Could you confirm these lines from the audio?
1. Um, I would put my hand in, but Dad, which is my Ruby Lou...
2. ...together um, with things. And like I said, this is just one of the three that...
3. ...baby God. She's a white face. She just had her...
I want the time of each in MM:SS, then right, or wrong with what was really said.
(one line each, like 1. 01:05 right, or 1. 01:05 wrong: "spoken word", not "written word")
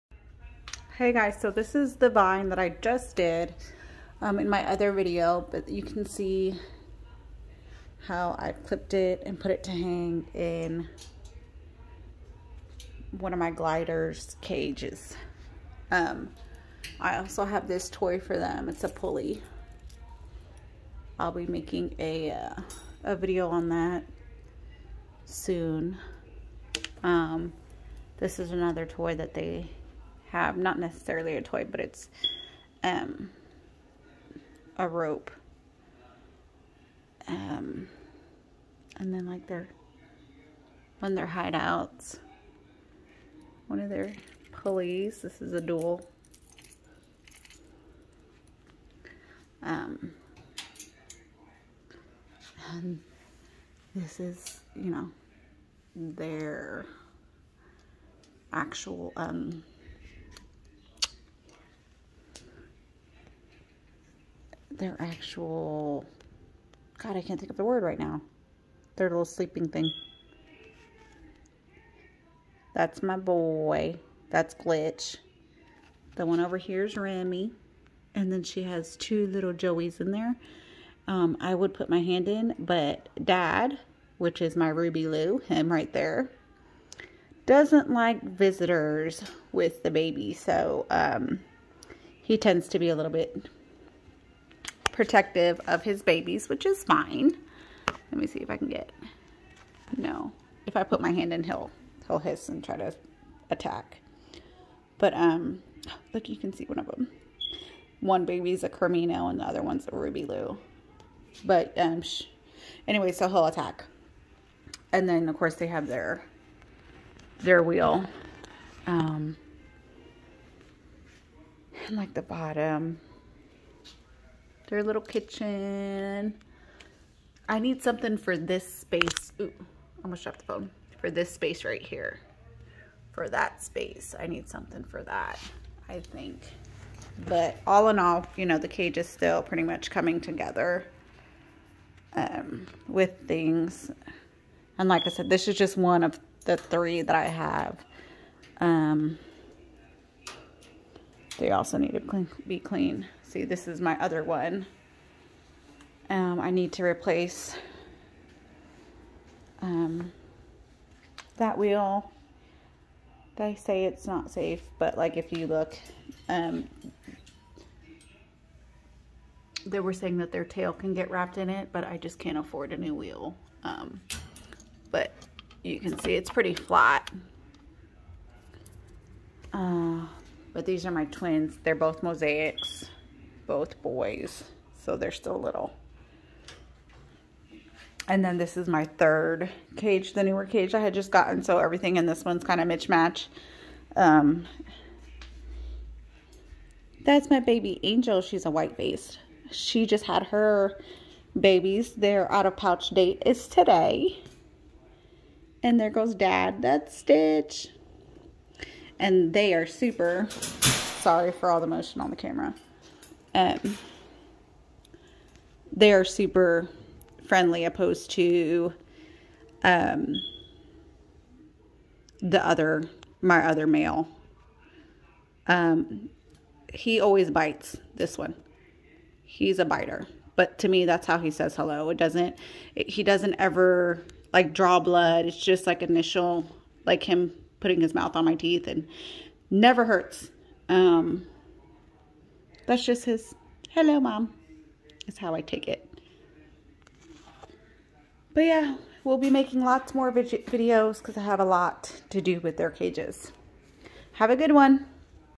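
1. 01:21 right
2. 02:20 right
3. 03:17 wrong: "Angel", not "God".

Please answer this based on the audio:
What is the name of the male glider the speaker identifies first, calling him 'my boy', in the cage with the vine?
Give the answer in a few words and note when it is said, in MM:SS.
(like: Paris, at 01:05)
Glitch, at 01:14.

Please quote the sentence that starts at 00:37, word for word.
Um, and then like their one of their hideouts, one of their pulleys.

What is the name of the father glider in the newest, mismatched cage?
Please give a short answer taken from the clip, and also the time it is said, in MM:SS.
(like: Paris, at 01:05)
Stitch, at 03:26.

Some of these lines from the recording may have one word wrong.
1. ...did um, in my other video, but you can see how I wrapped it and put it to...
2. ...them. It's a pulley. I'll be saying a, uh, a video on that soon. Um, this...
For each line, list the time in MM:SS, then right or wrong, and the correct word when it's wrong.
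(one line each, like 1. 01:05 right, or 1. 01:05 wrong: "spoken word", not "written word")
1. 00:03 wrong: "clipped", not "wrapped"
2. 00:18 wrong: "making", not "saying".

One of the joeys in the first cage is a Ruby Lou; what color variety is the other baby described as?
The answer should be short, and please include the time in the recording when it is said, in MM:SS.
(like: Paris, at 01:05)
Creamino, at 01:48.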